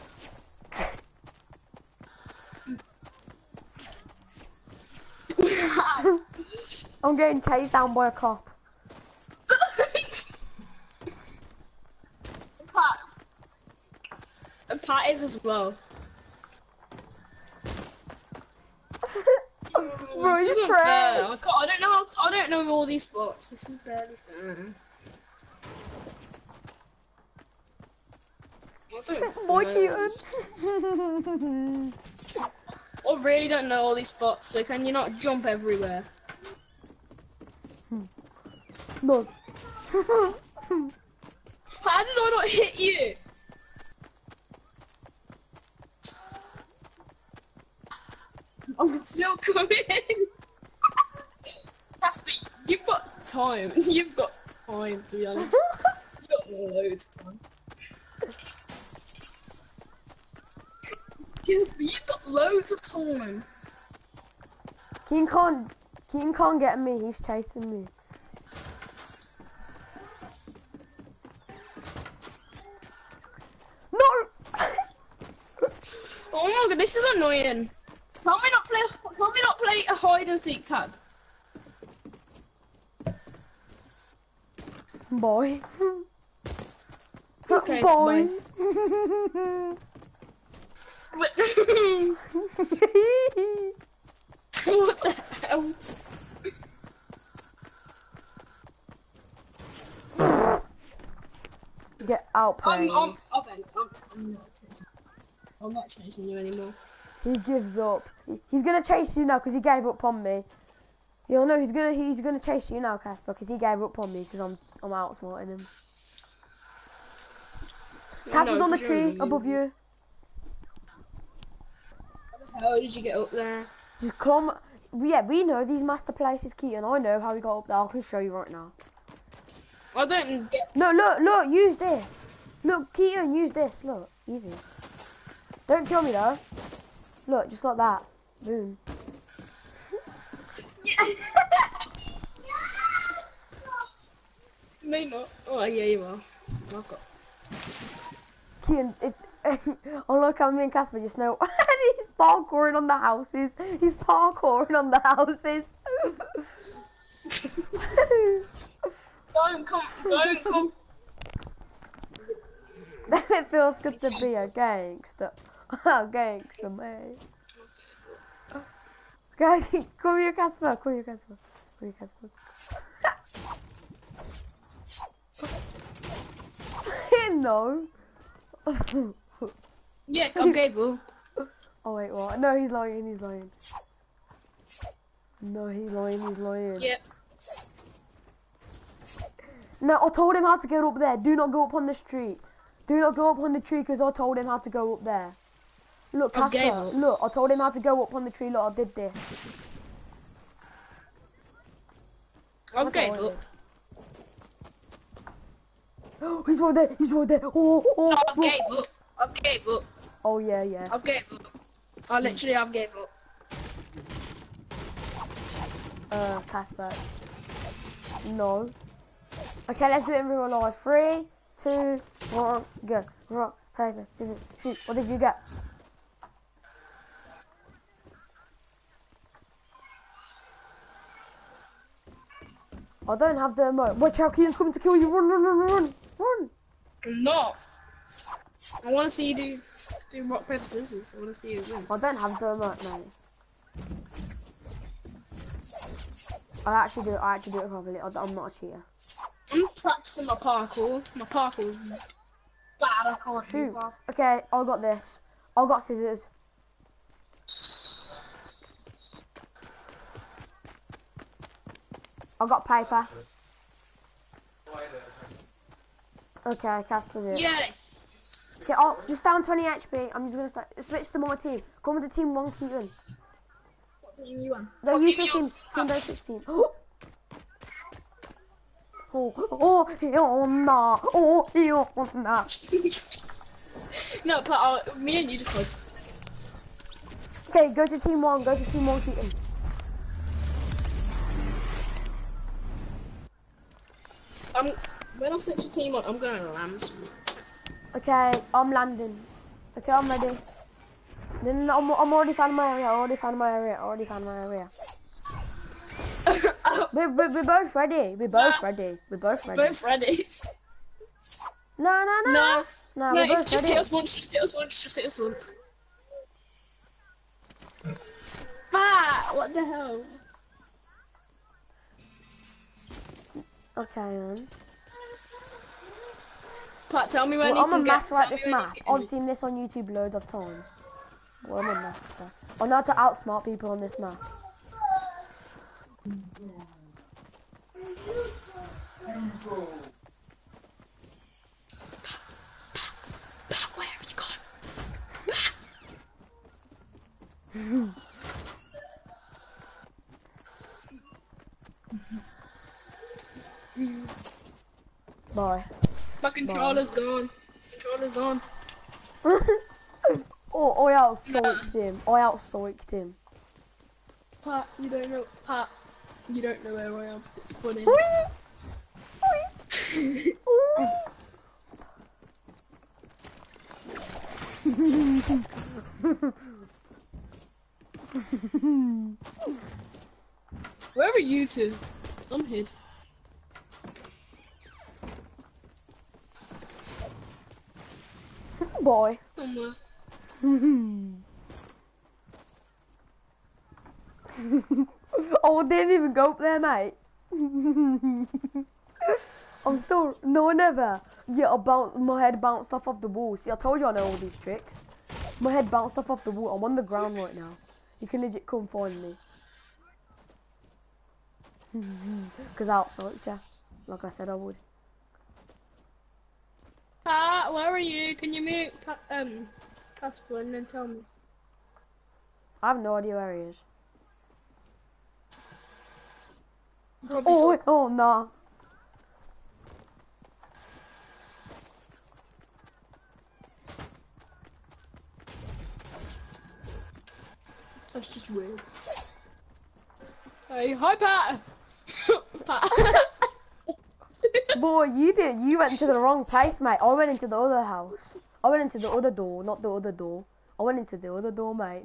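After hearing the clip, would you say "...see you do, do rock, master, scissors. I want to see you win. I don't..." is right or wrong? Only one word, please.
wrong.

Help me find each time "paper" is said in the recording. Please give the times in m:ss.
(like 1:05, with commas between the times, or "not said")
3:43, 4:00, 4:22.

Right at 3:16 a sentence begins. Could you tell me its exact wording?
Look, Casper, look, I told him how to go up on the tree, look, I did this.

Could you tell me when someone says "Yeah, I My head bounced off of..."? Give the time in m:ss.
6:41.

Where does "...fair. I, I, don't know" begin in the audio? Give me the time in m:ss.
0:20.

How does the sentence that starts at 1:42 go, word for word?
Get out, I'm, I'm, I'm, I'm not chasing you anymore.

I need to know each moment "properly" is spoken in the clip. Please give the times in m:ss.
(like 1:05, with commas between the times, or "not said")
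4:07.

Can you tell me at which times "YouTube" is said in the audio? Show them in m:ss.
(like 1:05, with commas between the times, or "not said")
5:29.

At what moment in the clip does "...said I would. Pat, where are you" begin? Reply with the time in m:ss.
6:54.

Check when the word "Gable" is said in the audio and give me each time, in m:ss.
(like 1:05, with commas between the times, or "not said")
3:00.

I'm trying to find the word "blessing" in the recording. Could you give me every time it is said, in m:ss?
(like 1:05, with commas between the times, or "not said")
not said.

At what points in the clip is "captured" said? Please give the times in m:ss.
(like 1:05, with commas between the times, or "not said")
4:26.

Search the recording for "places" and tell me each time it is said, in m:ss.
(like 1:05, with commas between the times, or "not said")
2:06, 7:26.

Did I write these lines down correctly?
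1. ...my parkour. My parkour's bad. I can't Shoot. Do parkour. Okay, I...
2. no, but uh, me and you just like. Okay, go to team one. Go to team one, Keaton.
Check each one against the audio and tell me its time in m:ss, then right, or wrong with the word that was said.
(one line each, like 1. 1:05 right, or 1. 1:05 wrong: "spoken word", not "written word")
1. 4:10 right
2. 4:44 right.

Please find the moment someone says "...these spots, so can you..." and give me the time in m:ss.
0:33.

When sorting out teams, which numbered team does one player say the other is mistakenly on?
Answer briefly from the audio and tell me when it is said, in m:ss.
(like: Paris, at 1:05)
16, at 4:35.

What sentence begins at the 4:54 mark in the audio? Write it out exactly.
I'm when I set your team on, I'm going to land.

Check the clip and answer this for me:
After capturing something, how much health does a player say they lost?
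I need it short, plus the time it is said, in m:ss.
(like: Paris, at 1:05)
20 HP, at 4:29.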